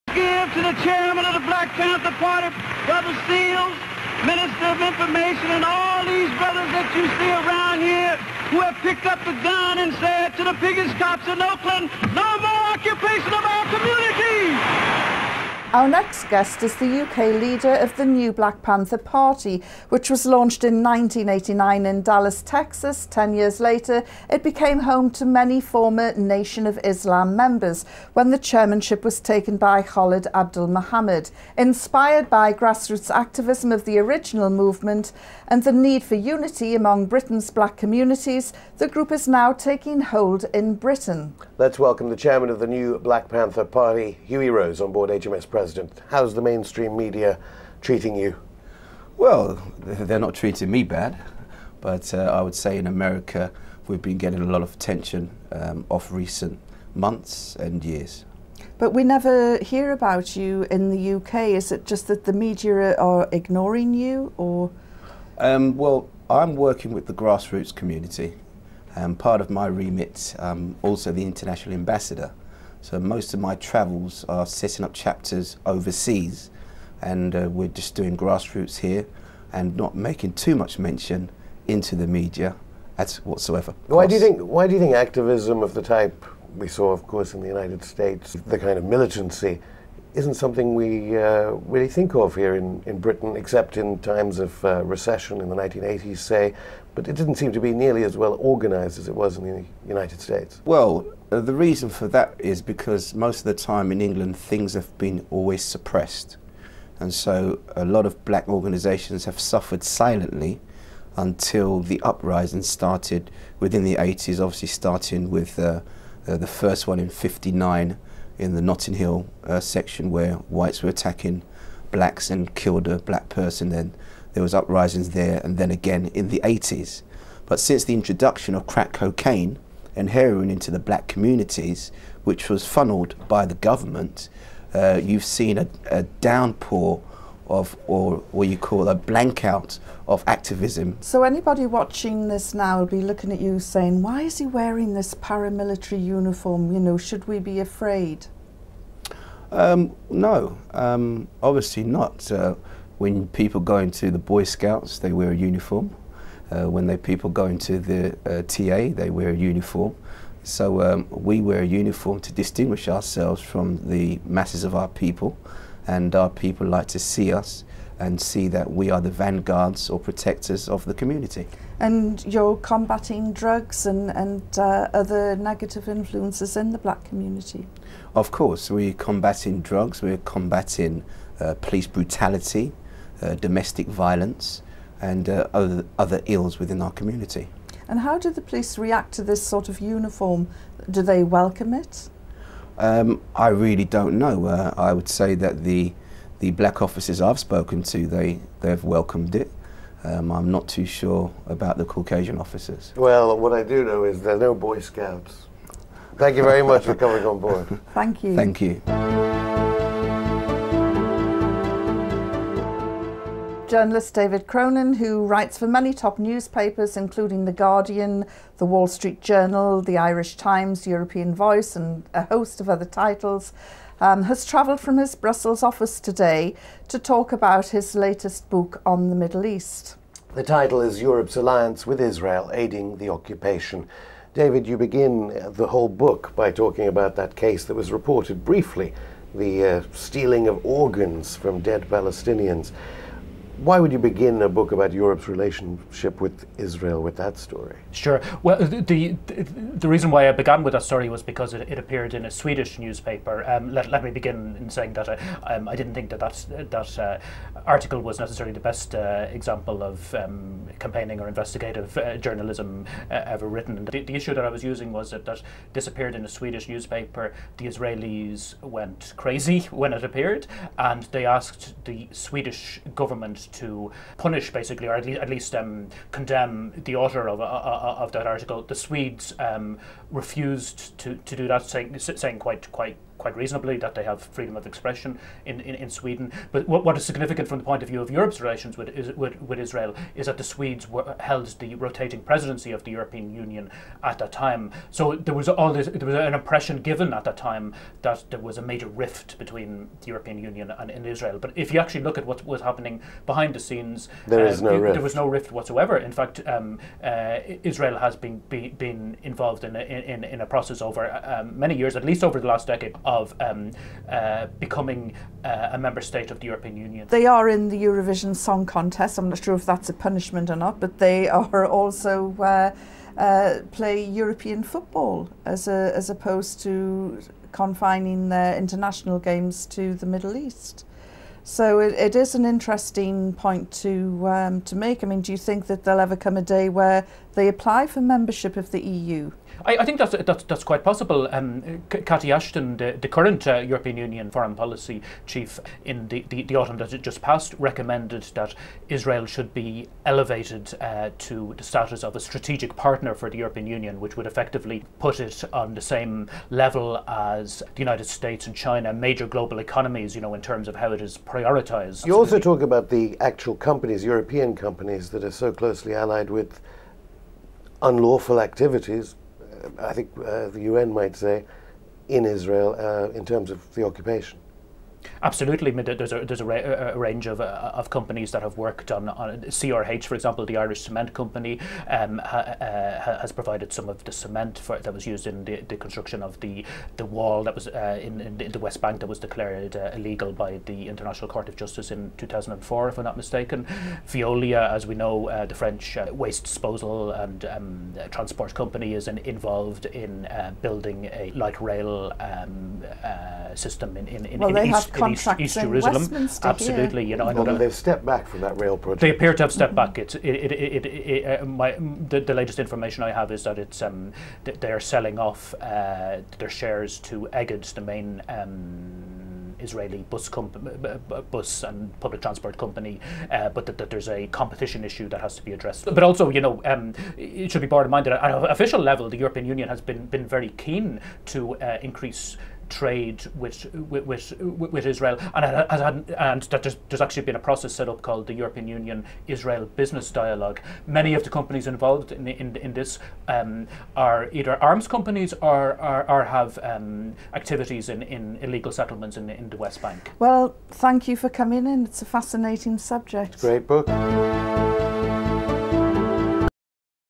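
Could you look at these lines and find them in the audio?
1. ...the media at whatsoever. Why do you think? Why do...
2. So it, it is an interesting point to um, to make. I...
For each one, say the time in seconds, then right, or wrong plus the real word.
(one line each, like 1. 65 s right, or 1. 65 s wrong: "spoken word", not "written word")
1. 81 s right
2. 331 s right.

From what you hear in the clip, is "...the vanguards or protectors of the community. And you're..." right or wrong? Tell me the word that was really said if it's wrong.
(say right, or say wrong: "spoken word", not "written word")
right.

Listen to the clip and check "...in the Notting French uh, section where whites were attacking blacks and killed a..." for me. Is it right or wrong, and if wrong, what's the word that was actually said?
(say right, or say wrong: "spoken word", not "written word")
wrong: "Hill", not "French".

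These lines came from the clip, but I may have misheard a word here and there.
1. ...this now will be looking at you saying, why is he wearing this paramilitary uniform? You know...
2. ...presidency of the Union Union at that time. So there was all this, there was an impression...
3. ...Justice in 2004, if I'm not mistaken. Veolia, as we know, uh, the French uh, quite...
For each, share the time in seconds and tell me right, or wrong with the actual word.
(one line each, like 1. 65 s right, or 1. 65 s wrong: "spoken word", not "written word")
1. 142 s right
2. 292 s wrong: "European", not "Union"
3. 391 s wrong: "waste", not "quite".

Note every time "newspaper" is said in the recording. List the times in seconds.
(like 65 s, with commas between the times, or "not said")
216 s, 252 s, 266 s.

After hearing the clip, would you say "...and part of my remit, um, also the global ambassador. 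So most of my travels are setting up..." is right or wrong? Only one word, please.
wrong.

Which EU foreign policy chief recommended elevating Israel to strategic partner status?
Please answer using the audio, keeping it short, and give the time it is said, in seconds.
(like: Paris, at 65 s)
Cathy Ashton, at 341 s.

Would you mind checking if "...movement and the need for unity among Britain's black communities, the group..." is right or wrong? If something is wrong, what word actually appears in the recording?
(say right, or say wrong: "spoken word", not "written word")
right.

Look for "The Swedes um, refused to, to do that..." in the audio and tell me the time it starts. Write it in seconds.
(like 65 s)
278 s.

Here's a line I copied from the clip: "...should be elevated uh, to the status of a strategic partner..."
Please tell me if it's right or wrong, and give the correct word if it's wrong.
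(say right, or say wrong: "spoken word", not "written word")
right.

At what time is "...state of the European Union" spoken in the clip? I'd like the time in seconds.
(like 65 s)
316 s.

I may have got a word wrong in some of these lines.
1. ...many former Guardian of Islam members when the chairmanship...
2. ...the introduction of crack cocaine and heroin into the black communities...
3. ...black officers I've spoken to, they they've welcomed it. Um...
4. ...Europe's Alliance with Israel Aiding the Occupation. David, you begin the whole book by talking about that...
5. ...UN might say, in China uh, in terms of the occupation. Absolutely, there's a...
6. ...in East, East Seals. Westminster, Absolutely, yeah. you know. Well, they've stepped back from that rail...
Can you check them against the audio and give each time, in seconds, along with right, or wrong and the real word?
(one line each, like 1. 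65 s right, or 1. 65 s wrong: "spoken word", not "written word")
1. 25 s wrong: "Nation", not "Guardian"
2. 127 s right
3. 196 s right
4. 231 s right
5. 370 s wrong: "Israel", not "China"
6. 405 s wrong: "Jerusalem", not "Seals".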